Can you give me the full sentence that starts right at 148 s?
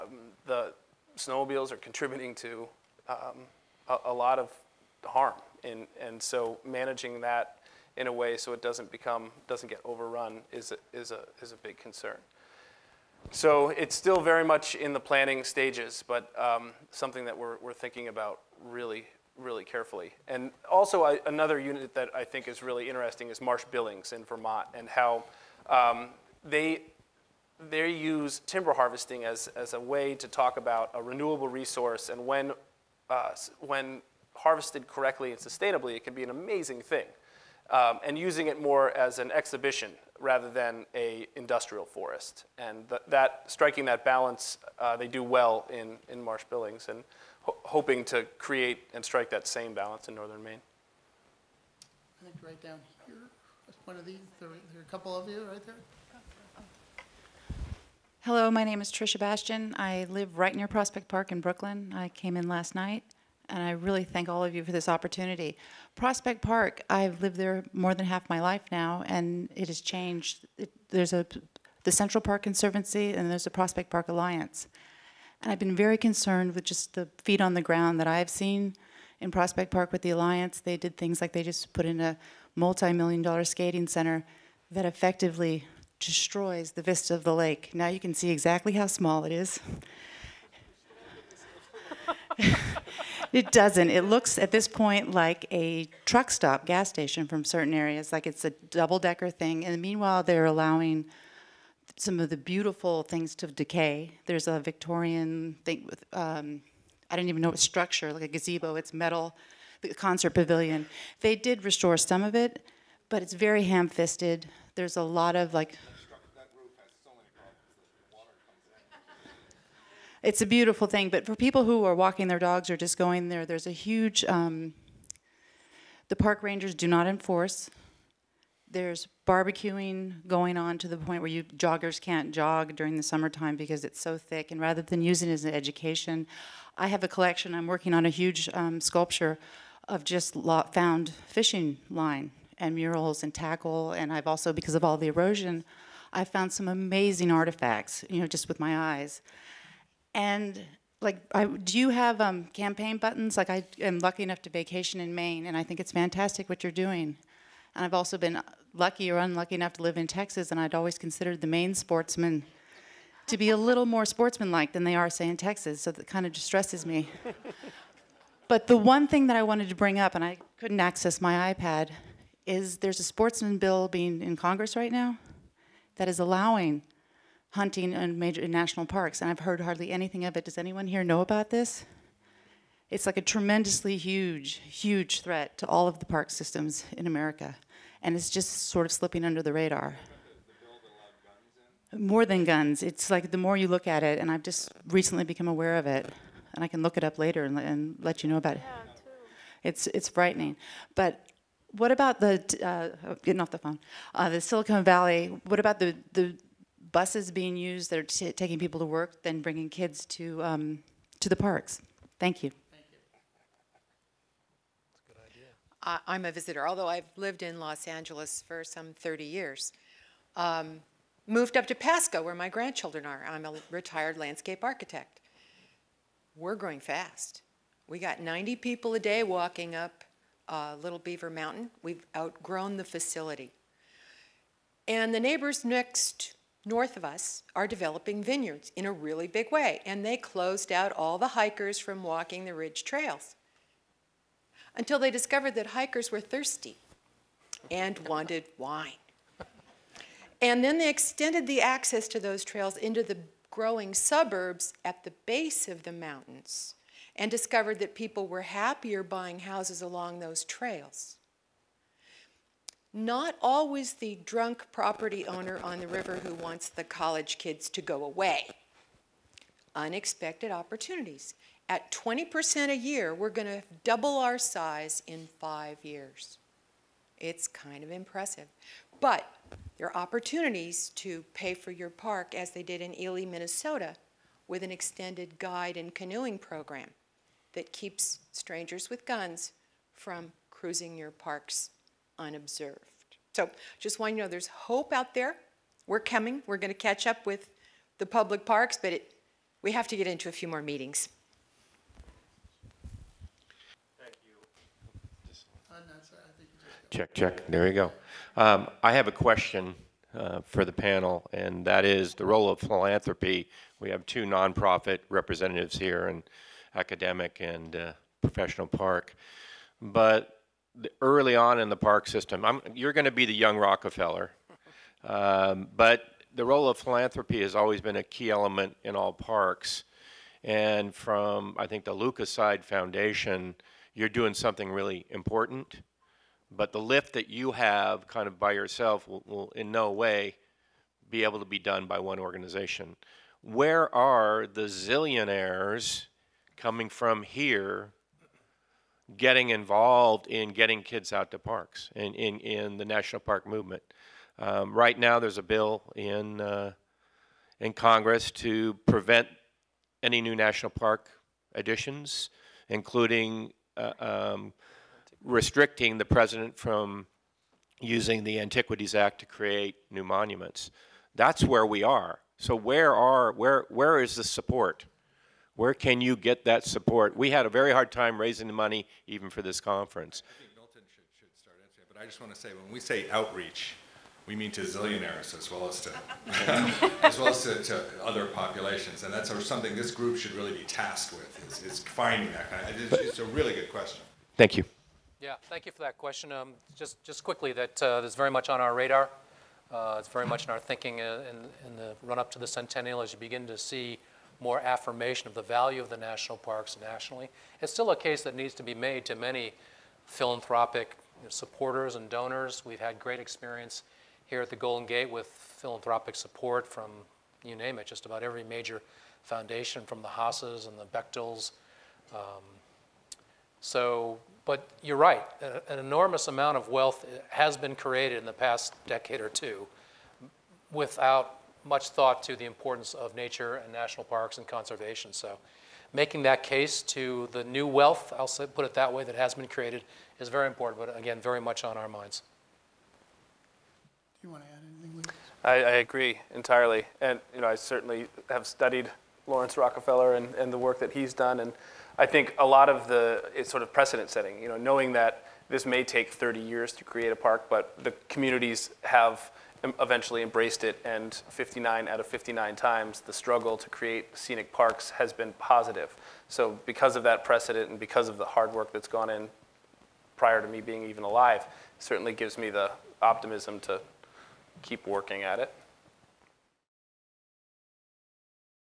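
You know, just with my eyes.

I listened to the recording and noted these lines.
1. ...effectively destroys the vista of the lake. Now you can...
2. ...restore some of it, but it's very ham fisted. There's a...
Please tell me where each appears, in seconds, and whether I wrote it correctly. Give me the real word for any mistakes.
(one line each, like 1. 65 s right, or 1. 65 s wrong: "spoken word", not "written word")
1. 84 s right
2. 111 s right.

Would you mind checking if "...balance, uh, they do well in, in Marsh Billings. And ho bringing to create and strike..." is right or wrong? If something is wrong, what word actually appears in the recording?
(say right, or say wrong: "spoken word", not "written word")
wrong: "hoping", not "bringing".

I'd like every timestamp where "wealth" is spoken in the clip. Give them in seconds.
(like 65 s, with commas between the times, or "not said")
426 s, 437 s.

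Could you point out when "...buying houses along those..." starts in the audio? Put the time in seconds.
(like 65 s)
259 s.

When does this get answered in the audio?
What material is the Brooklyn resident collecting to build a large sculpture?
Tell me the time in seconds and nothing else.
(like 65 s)
141 s.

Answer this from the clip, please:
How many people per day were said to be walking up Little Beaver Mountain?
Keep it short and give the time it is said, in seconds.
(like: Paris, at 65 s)
90, at 228 s.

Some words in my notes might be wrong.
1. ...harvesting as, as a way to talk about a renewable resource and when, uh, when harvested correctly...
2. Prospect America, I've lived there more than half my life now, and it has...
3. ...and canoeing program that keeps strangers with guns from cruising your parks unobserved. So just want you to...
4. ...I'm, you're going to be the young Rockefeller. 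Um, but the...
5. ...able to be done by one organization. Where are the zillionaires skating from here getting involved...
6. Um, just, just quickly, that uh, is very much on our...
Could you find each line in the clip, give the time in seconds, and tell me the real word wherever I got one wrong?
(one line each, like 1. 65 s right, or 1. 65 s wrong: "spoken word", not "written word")
1. 28 s right
2. 65 s wrong: "Park", not "America"
3. 285 s right
4. 322 s right
5. 341 s wrong: "coming", not "skating"
6. 396 s right.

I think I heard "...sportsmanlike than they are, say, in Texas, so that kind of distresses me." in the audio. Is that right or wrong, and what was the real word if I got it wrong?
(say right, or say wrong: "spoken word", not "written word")
right.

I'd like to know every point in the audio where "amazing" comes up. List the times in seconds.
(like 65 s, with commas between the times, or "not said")
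36 s, 146 s.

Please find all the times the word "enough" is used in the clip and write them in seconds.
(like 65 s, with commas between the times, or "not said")
154 s, 159 s.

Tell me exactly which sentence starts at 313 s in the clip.
We have two nonprofit representatives here, in academic and uh, professional park.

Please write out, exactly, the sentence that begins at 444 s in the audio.
Do you want to add anything, Lucas?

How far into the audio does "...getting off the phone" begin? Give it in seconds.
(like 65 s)
203 s.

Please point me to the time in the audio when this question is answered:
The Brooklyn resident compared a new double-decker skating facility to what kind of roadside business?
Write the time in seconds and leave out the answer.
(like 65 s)
96 s.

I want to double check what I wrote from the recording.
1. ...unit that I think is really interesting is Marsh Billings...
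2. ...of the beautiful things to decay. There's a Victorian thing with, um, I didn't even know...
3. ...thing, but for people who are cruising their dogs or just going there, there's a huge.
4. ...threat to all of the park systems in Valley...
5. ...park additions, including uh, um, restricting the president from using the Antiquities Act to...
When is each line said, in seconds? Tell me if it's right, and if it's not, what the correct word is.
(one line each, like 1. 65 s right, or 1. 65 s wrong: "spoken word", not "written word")
1. 21 s right
2. 102 s right
3. 120 s wrong: "walking", not "cruising"
4. 185 s wrong: "America", not "Valley"
5. 360 s right.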